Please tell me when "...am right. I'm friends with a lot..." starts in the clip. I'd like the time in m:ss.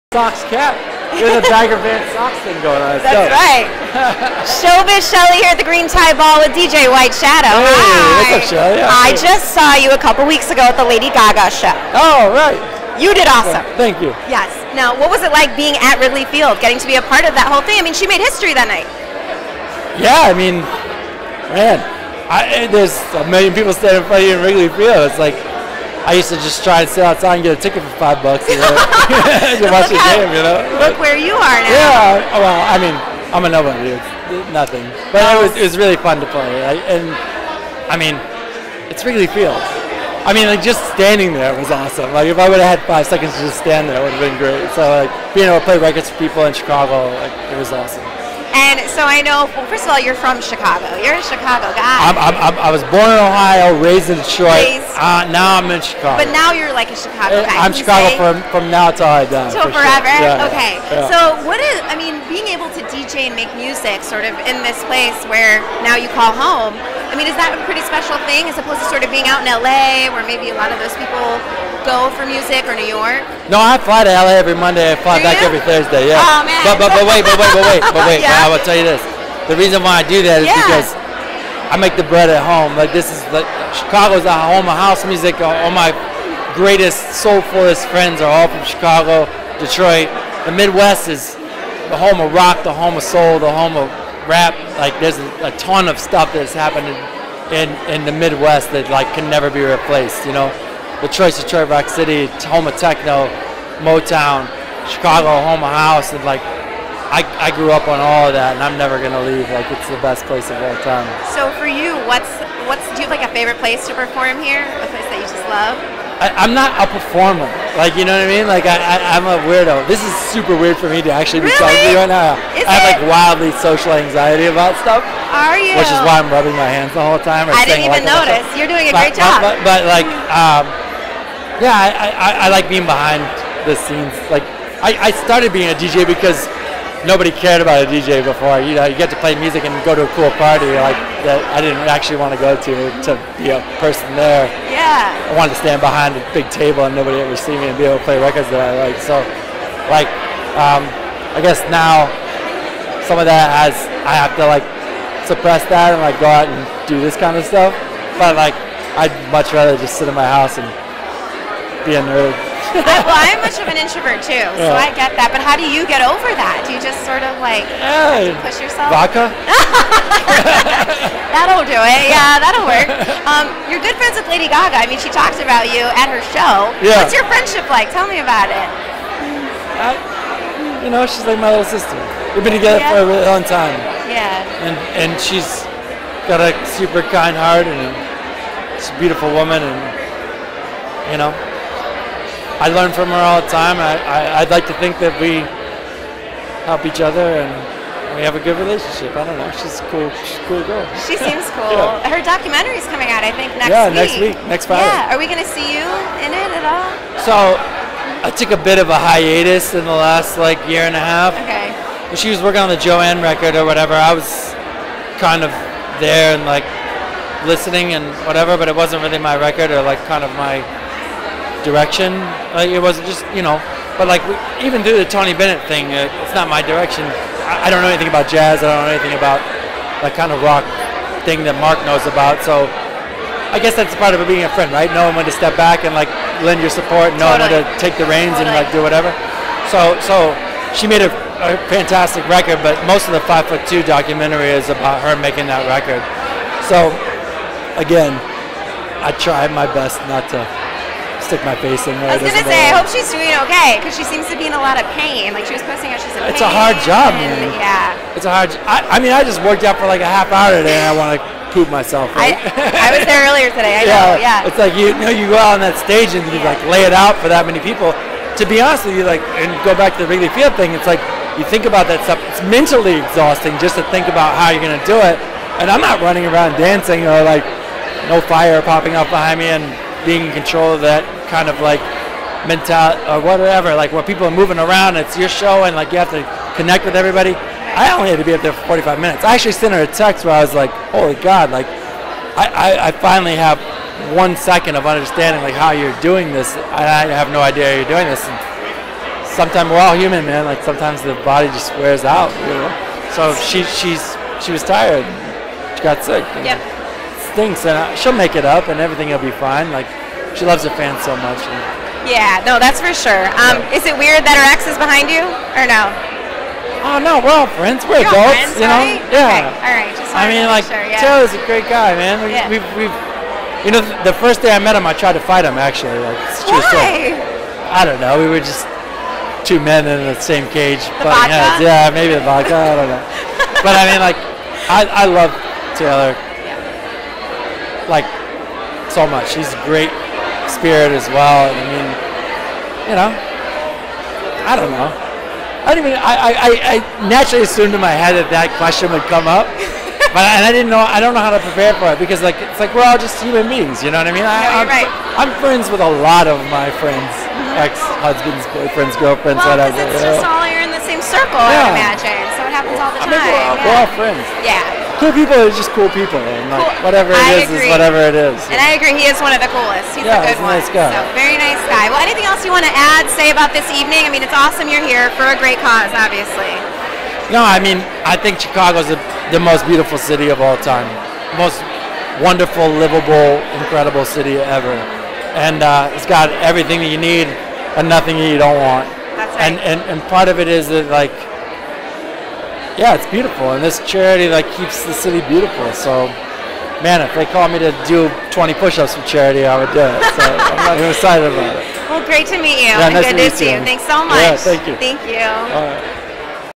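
5:54.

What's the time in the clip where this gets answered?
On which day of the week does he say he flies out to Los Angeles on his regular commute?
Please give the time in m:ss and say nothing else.
1:14.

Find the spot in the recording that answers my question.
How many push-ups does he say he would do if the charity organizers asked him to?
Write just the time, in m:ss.
6:38.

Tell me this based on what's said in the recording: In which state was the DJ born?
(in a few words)
Ohio.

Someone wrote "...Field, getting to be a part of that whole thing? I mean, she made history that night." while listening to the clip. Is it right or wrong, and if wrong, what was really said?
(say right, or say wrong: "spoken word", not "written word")
right.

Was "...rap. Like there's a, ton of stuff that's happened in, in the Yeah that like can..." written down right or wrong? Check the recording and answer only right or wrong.
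wrong.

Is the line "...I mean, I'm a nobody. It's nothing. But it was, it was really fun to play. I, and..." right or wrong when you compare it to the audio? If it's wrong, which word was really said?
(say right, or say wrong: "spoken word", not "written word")
right.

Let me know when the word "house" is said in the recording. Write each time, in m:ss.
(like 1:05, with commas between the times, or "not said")
1:24, 1:45, 2:40.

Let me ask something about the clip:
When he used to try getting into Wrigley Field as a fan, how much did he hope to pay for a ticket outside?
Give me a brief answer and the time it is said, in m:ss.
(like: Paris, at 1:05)
5 bucks, at 0:28.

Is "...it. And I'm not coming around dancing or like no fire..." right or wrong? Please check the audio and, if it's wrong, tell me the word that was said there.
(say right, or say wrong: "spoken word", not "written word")
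wrong: "running", not "coming".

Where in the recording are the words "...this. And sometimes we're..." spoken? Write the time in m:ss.
4:58.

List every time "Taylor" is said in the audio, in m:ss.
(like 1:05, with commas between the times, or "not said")
5:21, 5:35.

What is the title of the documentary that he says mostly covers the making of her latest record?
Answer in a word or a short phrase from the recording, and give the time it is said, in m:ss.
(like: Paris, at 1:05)
Five Foot Two, at 4:03.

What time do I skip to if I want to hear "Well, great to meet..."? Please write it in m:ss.
6:41.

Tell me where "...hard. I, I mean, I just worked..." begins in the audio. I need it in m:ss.
4:18.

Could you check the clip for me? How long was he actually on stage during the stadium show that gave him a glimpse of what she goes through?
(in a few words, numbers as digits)
45 minutes.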